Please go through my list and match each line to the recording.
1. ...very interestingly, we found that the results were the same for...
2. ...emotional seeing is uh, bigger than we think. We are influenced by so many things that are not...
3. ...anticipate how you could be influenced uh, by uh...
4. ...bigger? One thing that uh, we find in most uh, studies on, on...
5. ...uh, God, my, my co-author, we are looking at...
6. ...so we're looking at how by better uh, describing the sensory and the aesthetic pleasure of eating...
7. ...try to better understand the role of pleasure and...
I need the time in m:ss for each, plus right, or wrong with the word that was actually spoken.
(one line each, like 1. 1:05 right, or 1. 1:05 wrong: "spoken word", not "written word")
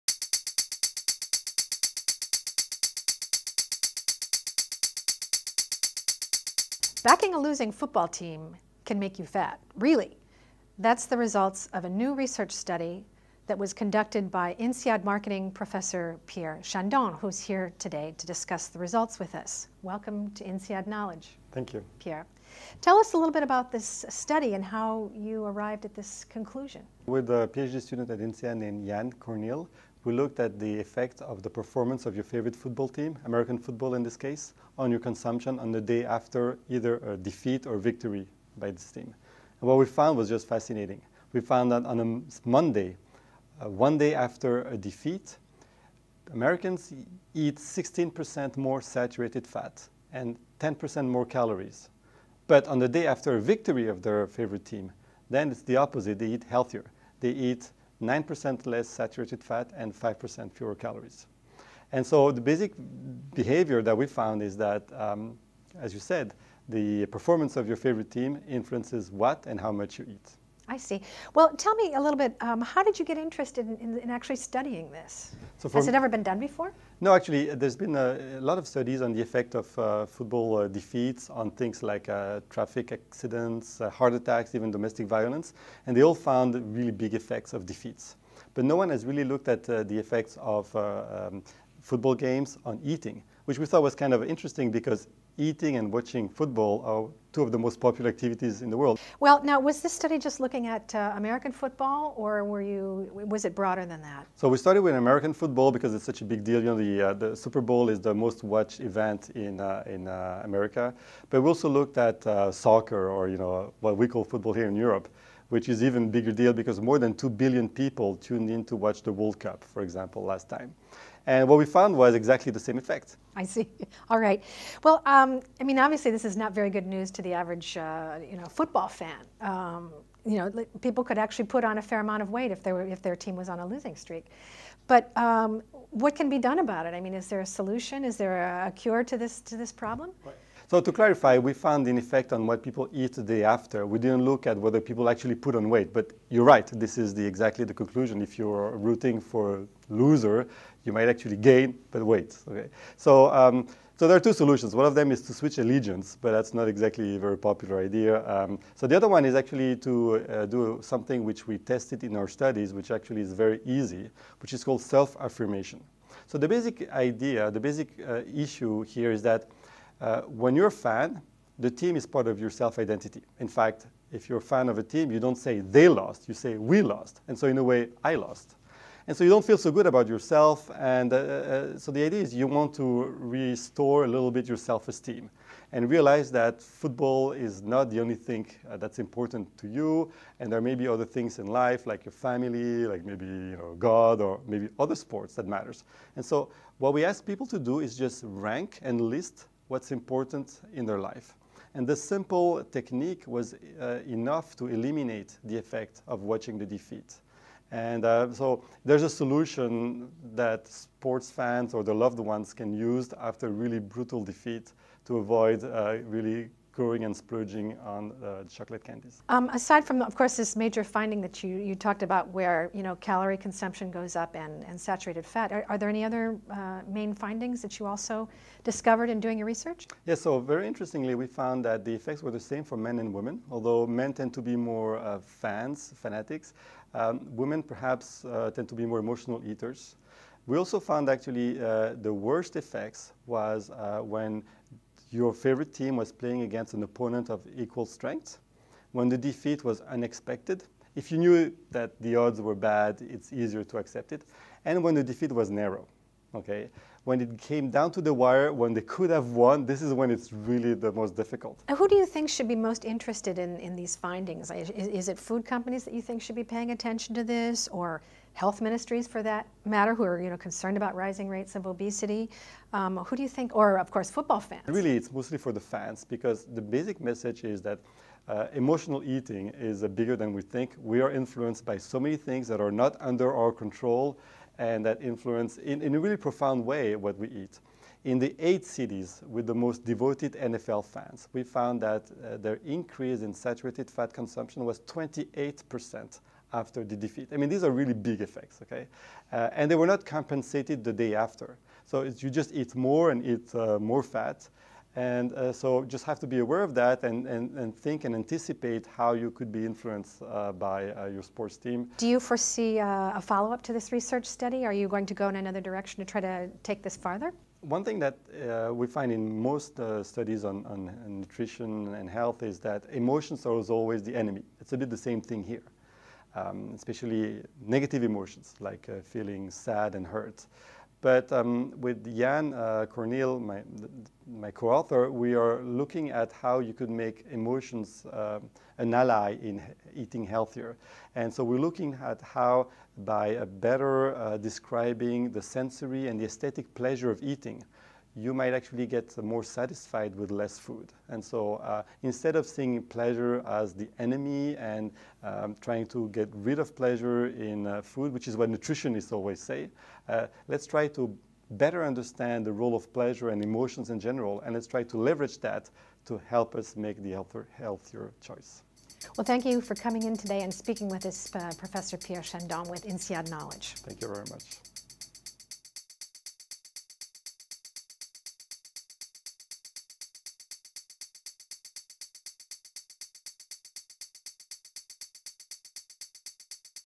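1. 3:50 wrong: "effects", not "results"
2. 4:38 wrong: "eating", not "seeing"
3. 5:08 right
4. 5:16 wrong: "farther", not "bigger"
5. 5:32 wrong: "Cornil", not "God"
6. 5:41 right
7. 6:00 right.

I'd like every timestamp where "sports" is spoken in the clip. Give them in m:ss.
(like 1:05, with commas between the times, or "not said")
3:14, 3:30, 5:11.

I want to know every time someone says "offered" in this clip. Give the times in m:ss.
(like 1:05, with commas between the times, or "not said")
not said.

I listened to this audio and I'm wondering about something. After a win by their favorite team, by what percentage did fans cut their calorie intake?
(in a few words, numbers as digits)
5%.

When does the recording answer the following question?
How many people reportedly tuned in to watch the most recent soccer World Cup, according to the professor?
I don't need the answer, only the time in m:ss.
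1:56.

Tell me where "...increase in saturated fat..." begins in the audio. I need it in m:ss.
4:52.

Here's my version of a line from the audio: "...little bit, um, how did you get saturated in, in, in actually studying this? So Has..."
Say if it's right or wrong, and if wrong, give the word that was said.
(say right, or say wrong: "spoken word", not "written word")
wrong: "interested", not "saturated".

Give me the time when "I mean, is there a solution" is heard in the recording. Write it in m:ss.
2:16.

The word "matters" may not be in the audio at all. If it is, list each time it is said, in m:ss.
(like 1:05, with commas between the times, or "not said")
3:15, 4:29.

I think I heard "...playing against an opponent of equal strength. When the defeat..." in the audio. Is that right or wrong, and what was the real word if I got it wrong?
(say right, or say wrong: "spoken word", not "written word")
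right.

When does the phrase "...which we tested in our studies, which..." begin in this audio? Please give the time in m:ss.
2:41.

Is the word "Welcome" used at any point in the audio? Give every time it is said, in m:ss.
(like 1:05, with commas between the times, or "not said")
0:19.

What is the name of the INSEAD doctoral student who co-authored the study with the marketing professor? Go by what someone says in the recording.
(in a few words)
Yann Cornil.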